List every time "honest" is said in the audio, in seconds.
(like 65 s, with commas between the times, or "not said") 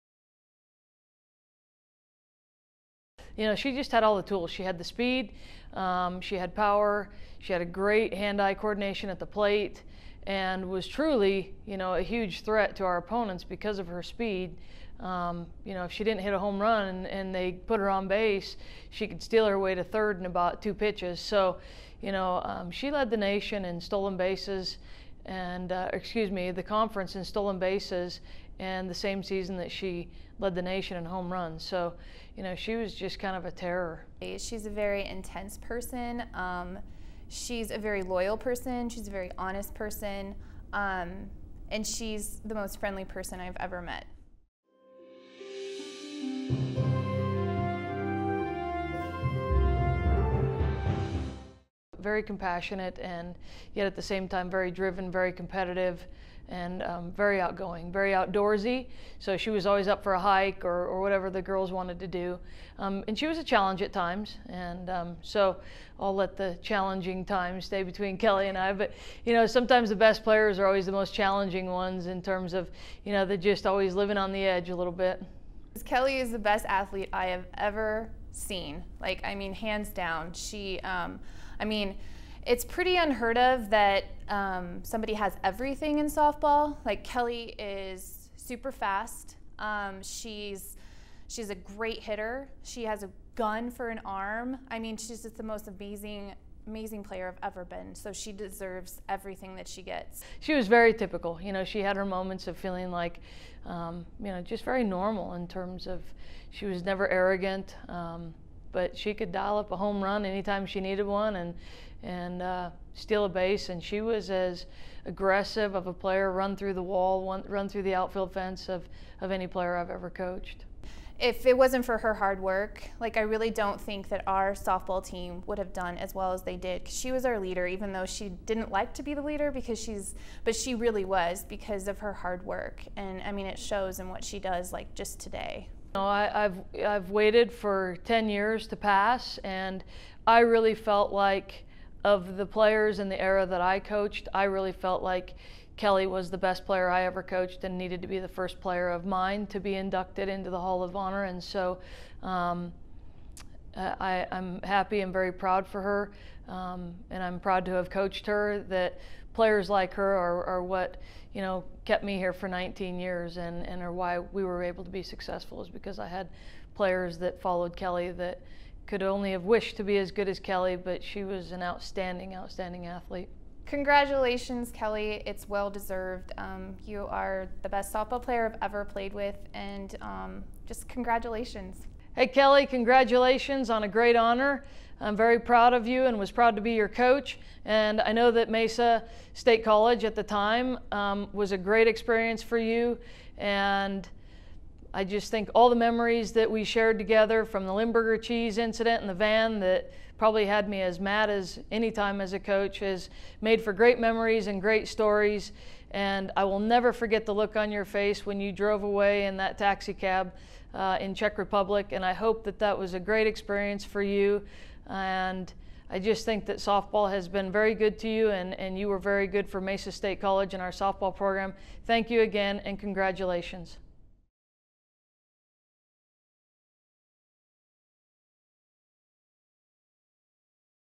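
39 s.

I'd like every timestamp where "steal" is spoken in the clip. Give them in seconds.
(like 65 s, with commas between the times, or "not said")
19 s, 112 s.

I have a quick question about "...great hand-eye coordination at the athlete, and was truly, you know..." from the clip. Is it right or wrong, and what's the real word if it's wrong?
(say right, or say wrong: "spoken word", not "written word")
wrong: "plate", not "athlete".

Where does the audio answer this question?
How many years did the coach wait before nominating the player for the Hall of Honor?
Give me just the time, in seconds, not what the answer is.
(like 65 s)
138 s.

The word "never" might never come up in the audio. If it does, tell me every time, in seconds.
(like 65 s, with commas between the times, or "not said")
106 s, 206 s.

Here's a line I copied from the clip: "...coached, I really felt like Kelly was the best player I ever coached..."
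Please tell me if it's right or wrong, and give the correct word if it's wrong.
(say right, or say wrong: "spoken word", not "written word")
right.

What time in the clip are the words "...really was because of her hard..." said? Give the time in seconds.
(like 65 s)
130 s.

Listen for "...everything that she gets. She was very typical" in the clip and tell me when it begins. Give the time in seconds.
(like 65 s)
99 s.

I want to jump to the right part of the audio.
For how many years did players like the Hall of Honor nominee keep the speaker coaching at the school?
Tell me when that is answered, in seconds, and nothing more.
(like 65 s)
162 s.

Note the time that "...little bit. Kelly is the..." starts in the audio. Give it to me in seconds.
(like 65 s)
74 s.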